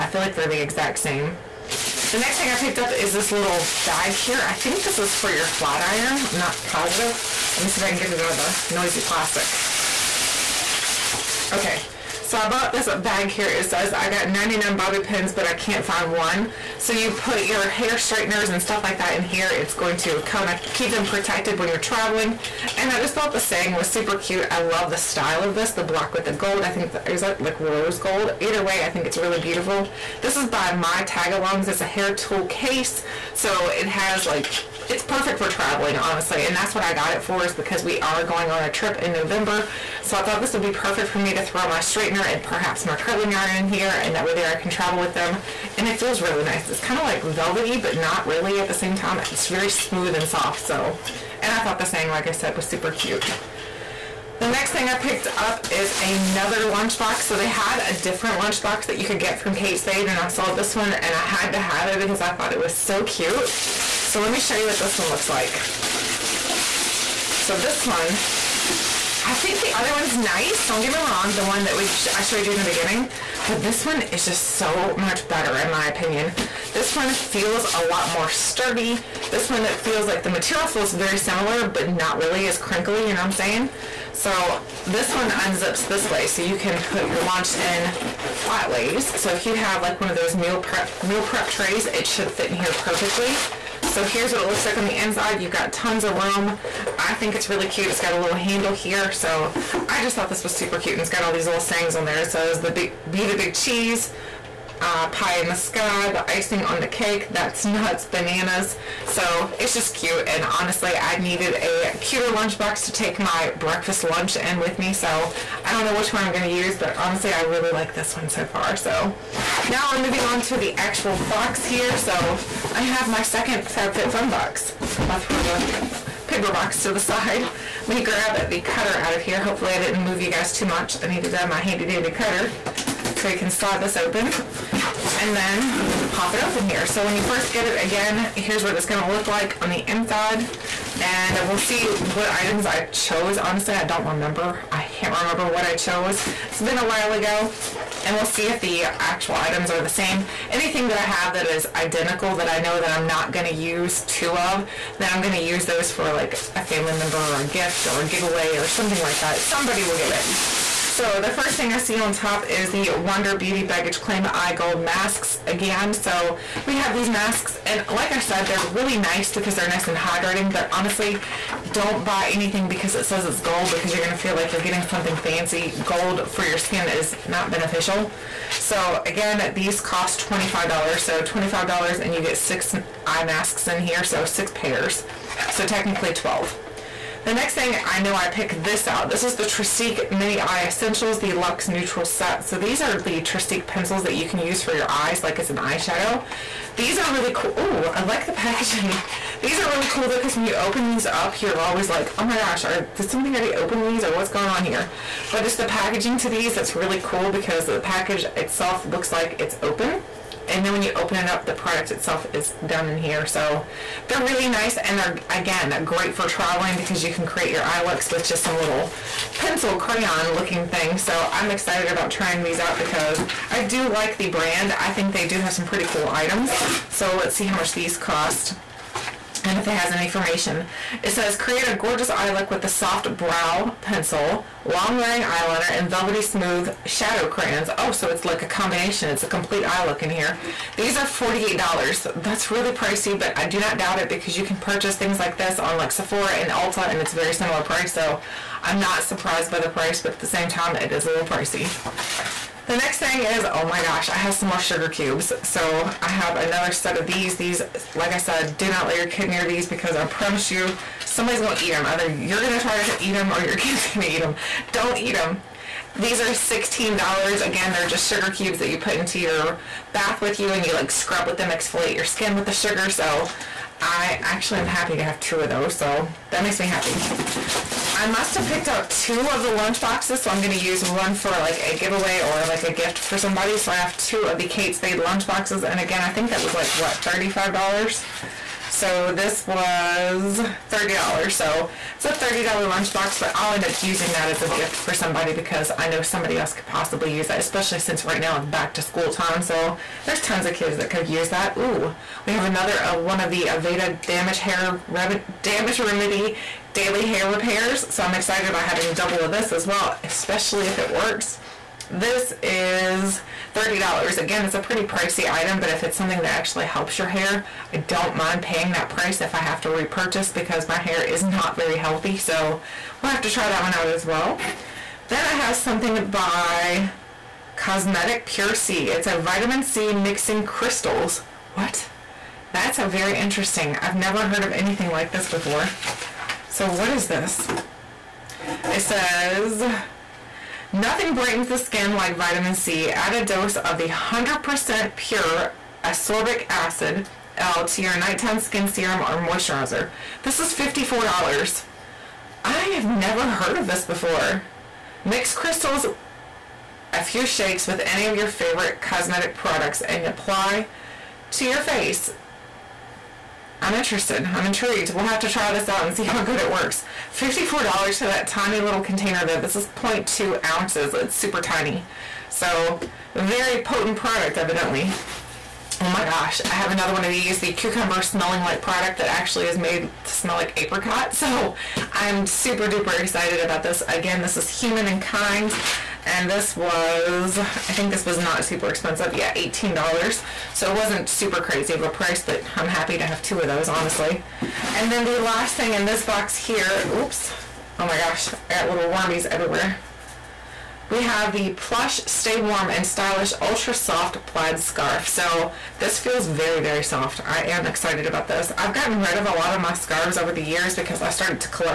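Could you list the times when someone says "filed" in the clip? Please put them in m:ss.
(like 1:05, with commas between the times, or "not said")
not said.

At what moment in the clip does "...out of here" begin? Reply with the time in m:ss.
2:08.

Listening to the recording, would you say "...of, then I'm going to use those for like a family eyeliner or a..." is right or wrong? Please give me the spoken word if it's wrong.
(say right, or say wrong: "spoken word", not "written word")
wrong: "member", not "eyeliner".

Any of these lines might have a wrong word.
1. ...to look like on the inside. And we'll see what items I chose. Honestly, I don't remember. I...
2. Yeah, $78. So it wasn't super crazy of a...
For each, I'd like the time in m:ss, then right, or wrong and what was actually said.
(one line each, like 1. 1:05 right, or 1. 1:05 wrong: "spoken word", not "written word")
1. 2:19 right
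2. 6:29 wrong: "18", not "78".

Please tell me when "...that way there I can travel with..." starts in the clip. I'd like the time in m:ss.
0:44.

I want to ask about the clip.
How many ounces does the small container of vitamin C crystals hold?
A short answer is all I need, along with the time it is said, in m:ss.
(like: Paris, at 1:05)
0.2 ounces, at 6:09.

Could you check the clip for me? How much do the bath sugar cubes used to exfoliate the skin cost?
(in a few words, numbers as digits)
$16.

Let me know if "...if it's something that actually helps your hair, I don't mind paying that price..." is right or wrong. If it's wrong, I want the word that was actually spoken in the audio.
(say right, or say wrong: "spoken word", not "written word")
right.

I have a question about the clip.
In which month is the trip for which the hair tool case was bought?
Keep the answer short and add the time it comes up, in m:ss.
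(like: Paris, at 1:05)
November, at 0:39.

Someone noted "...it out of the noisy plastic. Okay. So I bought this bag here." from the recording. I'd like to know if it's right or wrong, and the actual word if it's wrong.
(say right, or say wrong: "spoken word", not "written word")
right.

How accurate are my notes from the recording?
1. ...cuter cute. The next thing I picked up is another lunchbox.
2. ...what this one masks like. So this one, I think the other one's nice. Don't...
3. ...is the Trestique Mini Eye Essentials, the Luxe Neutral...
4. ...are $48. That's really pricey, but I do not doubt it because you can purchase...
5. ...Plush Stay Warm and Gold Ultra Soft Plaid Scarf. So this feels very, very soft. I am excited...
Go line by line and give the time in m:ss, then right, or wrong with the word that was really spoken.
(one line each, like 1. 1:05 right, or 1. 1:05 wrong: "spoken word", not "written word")
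1. 0:52 wrong: "super", not "cuter"
2. 1:04 wrong: "looks", not "masks"
3. 3:09 right
4. 4:00 right
5. 6:41 wrong: "Stylish", not "Gold".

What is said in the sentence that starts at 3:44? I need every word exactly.
I think they do have some pretty cool items.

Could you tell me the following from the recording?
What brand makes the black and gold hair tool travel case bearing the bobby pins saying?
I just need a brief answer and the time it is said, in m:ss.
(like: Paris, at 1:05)
My Tagalongs, at 0:30.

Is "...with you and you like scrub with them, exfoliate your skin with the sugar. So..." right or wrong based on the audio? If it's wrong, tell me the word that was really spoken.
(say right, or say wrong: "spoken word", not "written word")
right.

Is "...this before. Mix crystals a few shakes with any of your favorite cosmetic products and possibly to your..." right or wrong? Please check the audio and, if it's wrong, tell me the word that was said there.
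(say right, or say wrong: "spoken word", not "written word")
wrong: "apply", not "possibly".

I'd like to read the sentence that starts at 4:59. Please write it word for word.
So there's tons of kids that could use that.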